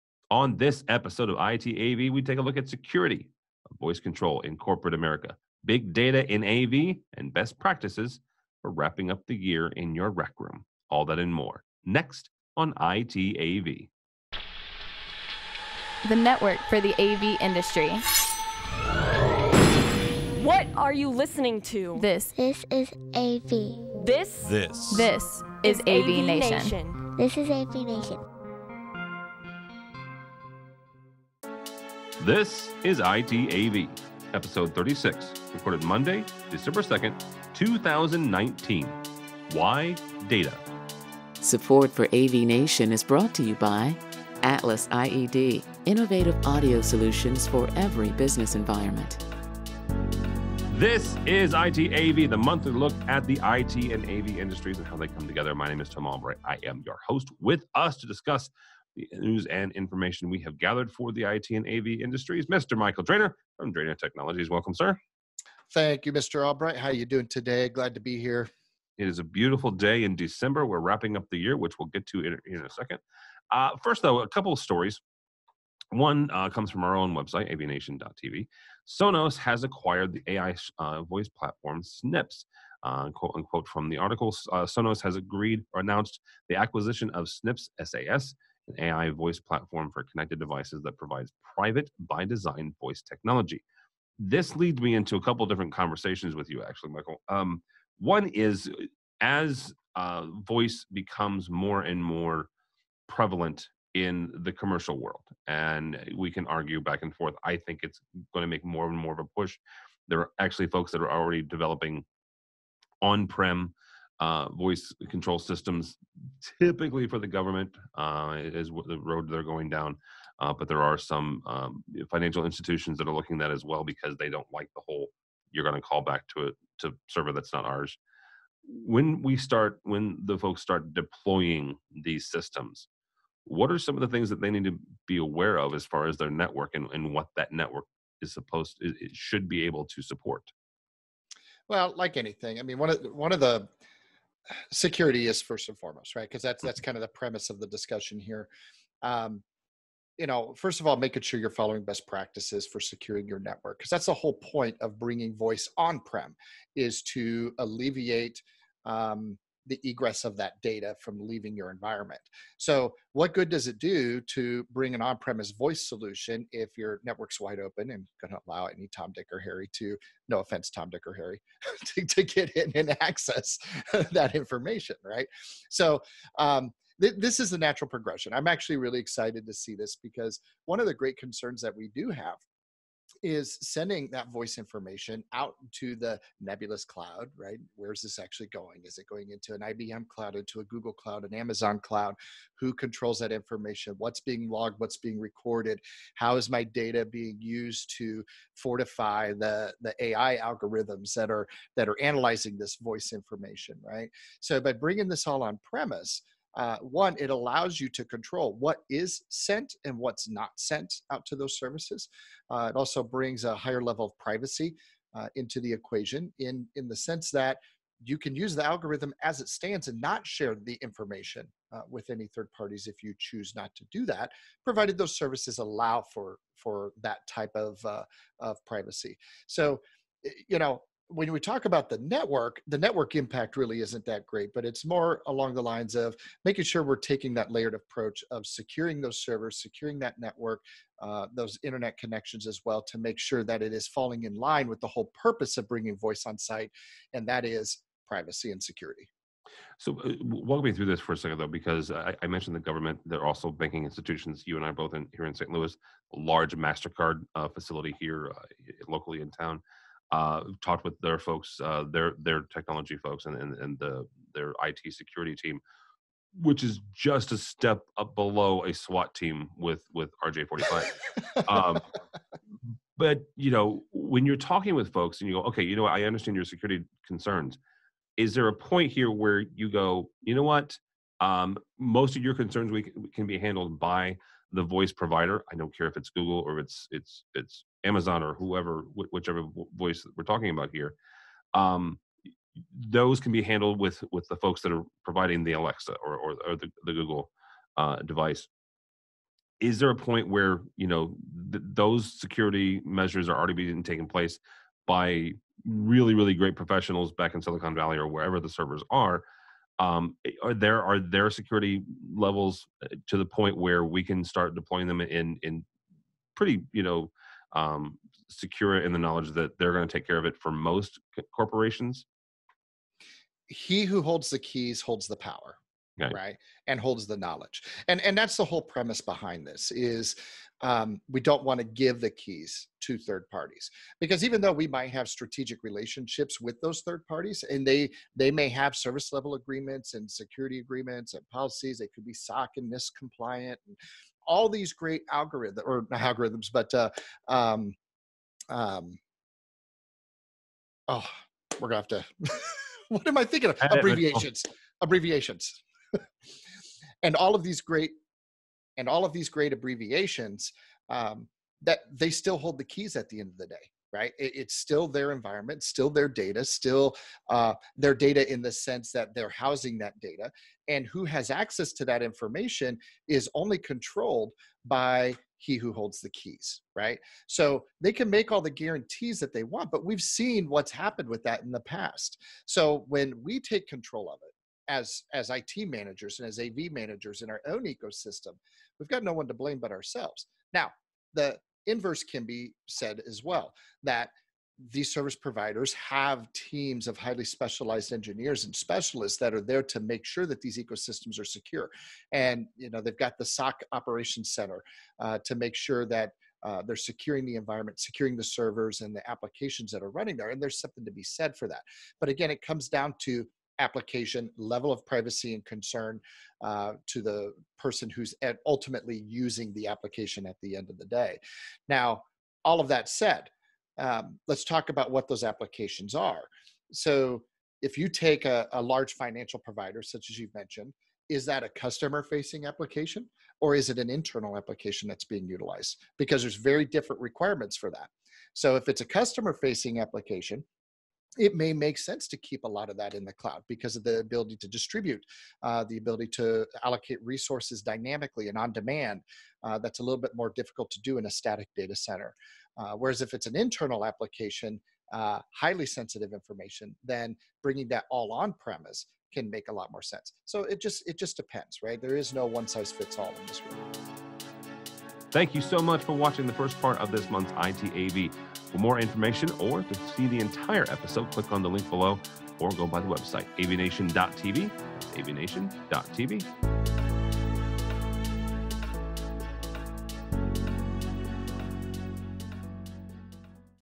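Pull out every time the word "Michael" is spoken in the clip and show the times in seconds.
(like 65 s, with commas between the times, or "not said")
62 s, 96 s.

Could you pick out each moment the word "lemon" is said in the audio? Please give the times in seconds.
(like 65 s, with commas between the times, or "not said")
not said.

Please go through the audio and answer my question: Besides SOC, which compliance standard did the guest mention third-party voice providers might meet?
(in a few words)
NIST.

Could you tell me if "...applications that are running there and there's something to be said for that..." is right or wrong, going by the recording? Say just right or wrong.
right.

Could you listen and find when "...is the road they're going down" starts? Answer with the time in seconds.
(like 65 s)
118 s.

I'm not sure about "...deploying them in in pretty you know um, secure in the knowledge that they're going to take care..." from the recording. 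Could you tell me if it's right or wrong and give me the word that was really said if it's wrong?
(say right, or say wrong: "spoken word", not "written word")
right.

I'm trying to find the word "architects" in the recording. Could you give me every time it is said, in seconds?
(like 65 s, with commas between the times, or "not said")
not said.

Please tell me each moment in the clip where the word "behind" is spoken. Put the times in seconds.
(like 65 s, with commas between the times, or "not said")
329 s.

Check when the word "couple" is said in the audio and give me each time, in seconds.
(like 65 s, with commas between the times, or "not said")
74 s, 95 s.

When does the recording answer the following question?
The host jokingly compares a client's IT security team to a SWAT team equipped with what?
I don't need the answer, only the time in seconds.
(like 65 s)
270 s.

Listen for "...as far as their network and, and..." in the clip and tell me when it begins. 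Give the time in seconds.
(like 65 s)
135 s.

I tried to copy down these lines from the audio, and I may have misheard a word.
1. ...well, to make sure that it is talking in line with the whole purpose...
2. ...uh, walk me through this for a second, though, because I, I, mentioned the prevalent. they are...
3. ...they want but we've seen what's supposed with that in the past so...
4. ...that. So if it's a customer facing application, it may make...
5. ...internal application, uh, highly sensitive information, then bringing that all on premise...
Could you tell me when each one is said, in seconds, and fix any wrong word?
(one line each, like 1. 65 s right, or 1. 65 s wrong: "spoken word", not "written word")
1. 242 s wrong: "falling", not "talking"
2. 250 s wrong: "government", not "prevalent"
3. 379 s wrong: "happened", not "supposed"
4. 437 s right
5. 453 s right.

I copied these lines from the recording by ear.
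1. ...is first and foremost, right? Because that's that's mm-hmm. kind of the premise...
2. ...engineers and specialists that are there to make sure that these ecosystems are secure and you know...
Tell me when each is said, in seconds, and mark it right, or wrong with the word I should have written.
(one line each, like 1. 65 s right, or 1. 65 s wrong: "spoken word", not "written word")
1. 145 s right
2. 397 s right.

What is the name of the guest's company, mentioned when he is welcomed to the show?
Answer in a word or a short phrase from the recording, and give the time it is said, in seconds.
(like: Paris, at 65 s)
Drainer Technologies, at 63 s.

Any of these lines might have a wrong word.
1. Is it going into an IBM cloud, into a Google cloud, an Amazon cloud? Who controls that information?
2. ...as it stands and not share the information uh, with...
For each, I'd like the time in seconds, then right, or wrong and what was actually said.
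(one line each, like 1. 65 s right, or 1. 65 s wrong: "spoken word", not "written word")
1. 188 s right
2. 219 s right.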